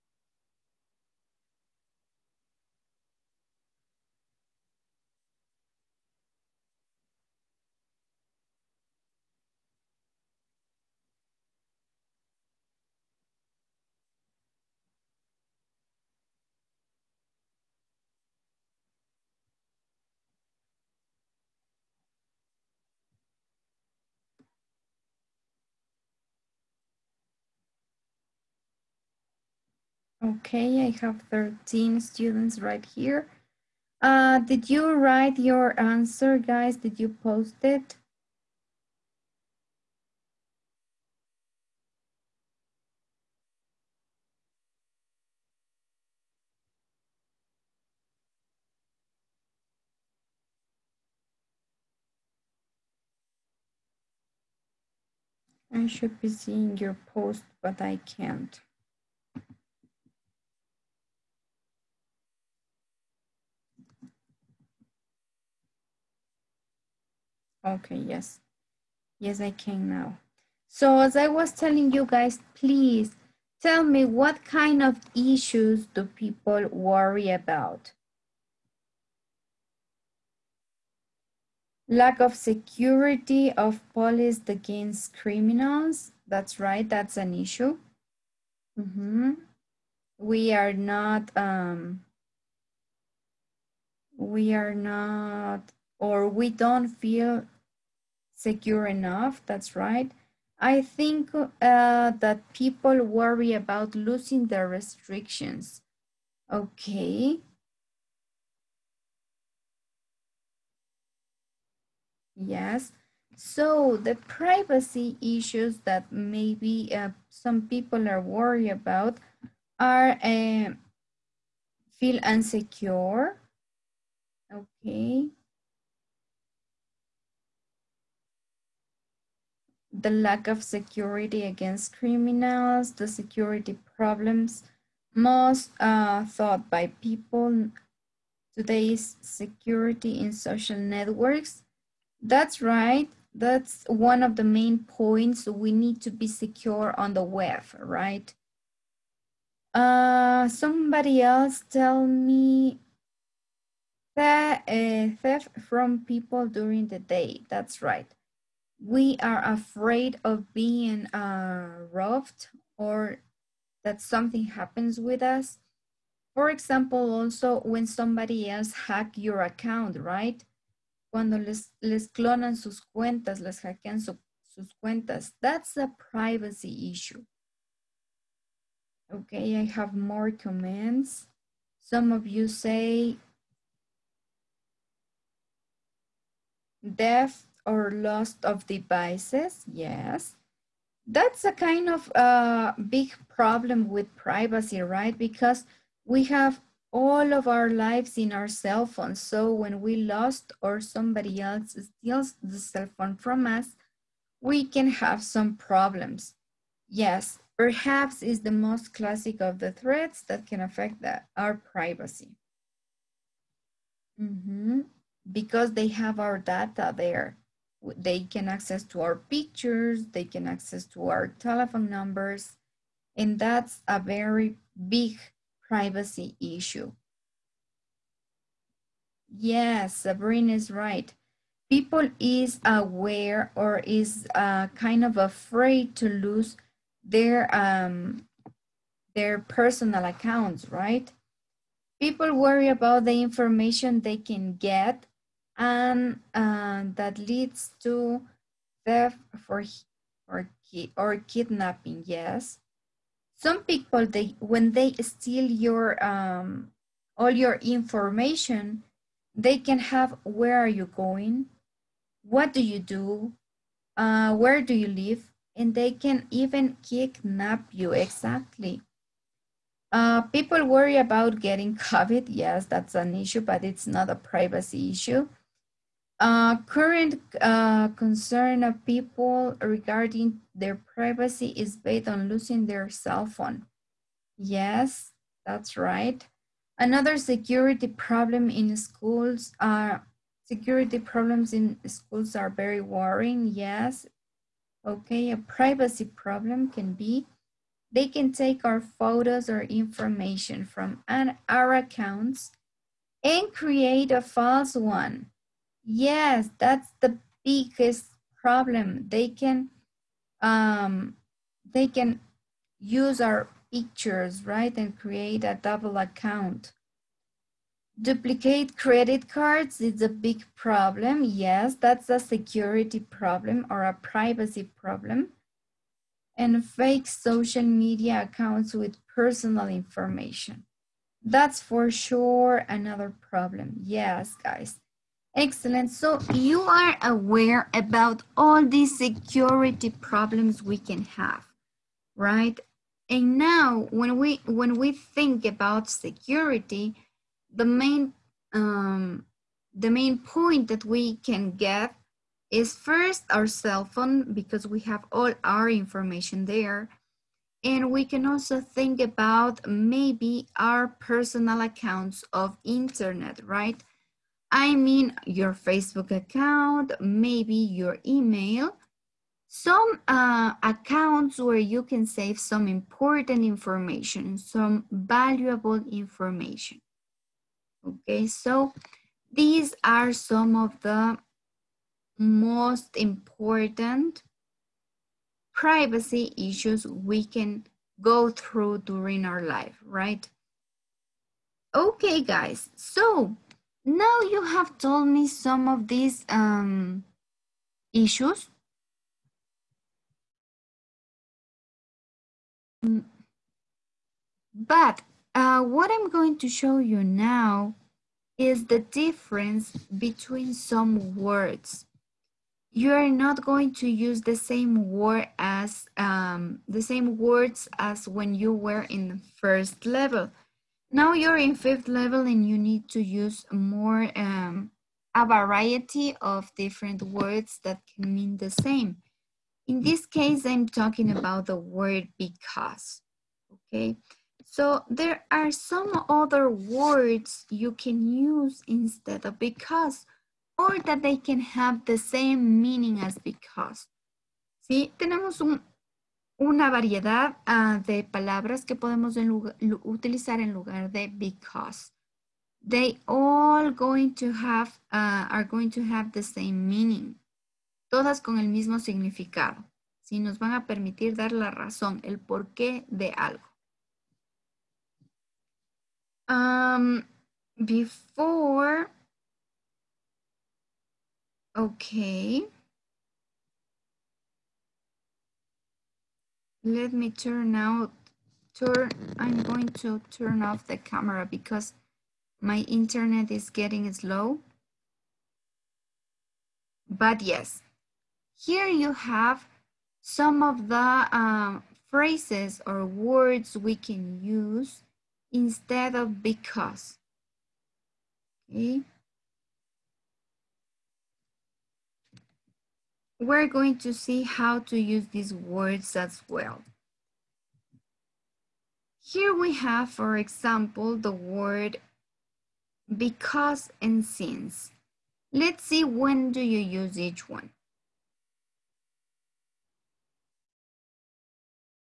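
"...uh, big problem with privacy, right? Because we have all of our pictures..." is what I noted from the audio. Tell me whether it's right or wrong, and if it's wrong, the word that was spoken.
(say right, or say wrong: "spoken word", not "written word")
wrong: "lives", not "pictures".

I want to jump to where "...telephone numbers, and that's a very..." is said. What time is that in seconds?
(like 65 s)
221 s.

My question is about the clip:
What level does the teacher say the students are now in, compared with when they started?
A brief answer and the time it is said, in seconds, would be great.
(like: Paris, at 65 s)
Fifth level, at 421 s.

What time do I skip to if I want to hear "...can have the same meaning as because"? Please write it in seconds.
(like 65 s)
441 s.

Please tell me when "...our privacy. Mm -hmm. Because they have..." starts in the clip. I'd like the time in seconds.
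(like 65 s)
211 s.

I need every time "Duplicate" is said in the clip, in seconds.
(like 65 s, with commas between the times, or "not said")
318 s.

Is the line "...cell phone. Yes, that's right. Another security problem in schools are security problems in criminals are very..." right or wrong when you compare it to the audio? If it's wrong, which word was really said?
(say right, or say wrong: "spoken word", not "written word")
wrong: "schools", not "criminals".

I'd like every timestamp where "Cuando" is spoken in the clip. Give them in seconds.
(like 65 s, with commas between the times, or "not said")
171 s.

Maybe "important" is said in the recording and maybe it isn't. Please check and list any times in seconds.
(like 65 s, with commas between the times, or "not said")
372 s, 382 s.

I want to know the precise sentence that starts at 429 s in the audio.
In this case, I'm talking about the word because, okay?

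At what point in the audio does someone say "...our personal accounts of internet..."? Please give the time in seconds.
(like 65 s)
360 s.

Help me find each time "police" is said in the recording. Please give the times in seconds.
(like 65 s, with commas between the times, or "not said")
83 s.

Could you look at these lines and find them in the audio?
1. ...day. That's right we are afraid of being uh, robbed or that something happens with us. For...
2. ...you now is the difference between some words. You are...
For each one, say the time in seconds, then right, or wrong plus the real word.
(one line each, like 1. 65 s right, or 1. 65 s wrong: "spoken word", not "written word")
1. 156 s right
2. 406 s right.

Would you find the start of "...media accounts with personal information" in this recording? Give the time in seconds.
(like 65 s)
327 s.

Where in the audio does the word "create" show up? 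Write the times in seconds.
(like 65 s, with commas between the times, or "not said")
303 s, 314 s.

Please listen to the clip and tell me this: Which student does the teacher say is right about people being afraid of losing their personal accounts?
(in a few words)
Sabrina.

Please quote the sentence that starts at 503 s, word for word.
we're going to see how to use these words as well.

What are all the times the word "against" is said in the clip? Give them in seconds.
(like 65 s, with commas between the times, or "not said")
84 s, 131 s.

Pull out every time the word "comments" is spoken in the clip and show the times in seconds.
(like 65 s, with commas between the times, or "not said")
180 s.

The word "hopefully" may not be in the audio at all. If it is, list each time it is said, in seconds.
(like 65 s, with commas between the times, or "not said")
not said.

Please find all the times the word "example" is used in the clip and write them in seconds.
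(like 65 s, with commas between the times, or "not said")
166 s, 510 s.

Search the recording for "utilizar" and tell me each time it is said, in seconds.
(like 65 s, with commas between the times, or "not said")
449 s.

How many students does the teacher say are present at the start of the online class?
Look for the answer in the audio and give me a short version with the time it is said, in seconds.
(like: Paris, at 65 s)
13, at 31 s.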